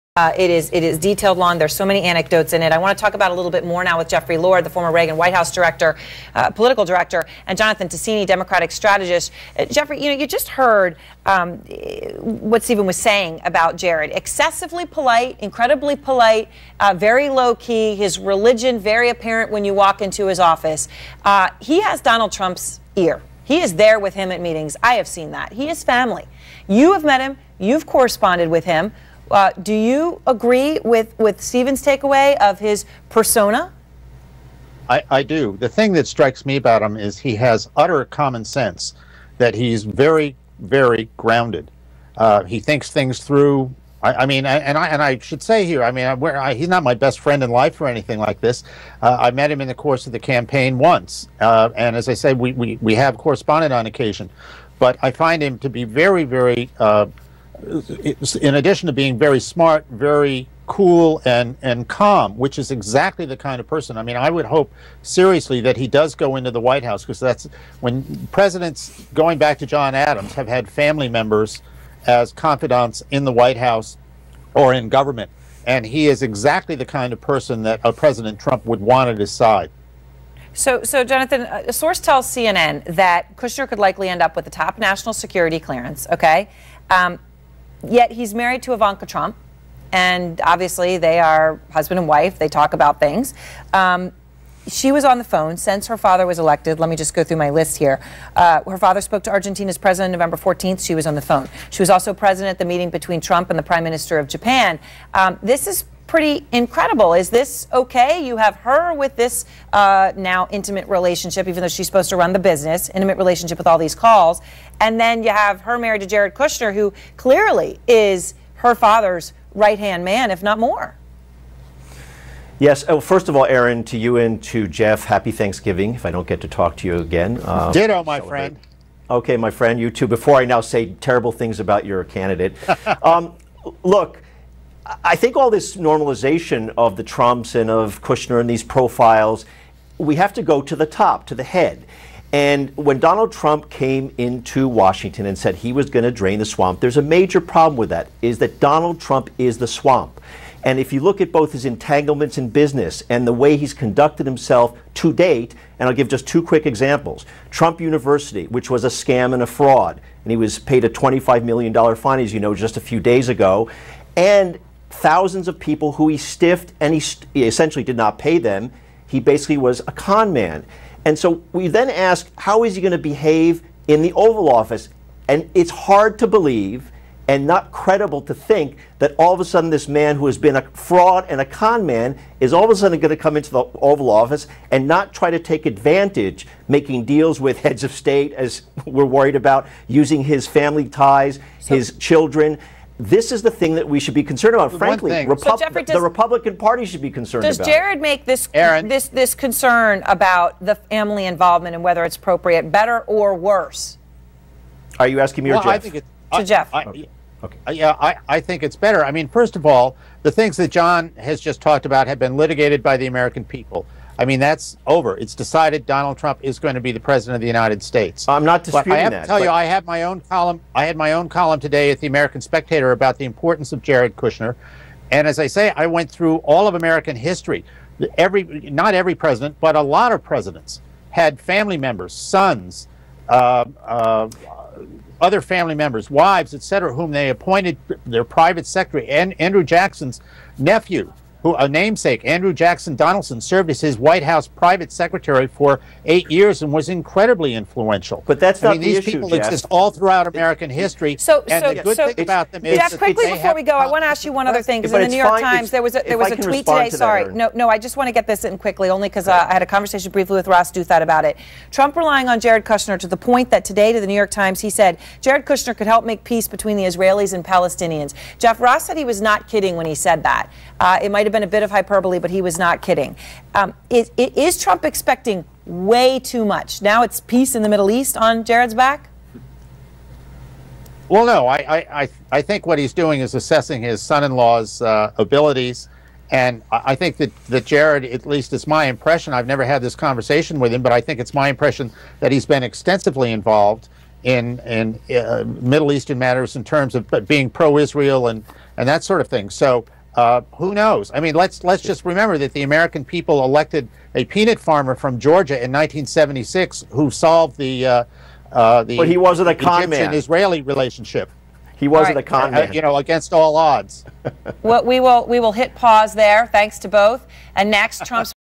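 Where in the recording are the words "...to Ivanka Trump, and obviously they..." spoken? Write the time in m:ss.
1:28.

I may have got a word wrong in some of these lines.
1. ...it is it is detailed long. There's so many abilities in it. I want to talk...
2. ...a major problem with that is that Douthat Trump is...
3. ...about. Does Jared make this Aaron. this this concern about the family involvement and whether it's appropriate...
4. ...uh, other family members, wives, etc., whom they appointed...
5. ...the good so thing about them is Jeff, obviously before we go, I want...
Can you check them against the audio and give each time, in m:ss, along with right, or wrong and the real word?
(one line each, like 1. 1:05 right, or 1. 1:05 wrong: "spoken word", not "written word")
1. 0:00 wrong: "anecdotes", not "abilities"
2. 2:26 wrong: "Donald", not "Douthat"
3. 3:17 right
4. 3:53 right
5. 4:11 wrong: "quickly", not "obviously".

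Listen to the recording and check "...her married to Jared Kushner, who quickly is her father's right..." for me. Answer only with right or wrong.
wrong.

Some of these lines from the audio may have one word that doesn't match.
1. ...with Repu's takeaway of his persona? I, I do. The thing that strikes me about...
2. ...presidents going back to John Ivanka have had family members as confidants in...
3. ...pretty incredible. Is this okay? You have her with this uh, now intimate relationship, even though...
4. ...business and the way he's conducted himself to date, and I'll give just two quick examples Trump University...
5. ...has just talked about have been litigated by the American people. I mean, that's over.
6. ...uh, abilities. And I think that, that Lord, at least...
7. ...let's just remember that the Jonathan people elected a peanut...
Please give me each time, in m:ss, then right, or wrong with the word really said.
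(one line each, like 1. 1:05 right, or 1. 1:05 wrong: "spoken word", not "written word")
1. 0:31 wrong: "Steven", not "Repu"
2. 1:08 wrong: "Adams", not "Ivanka"
3. 1:46 right
4. 2:32 right
5. 3:31 right
6. 4:44 wrong: "Jared", not "Lord"
7. 5:01 wrong: "American", not "Jonathan".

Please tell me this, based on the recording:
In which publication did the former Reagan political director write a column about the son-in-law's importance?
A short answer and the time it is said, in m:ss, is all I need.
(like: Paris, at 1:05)
American Spectator, at 3:42.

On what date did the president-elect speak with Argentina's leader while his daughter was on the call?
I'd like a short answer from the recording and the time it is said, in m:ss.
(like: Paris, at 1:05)
November 14th, at 1:40.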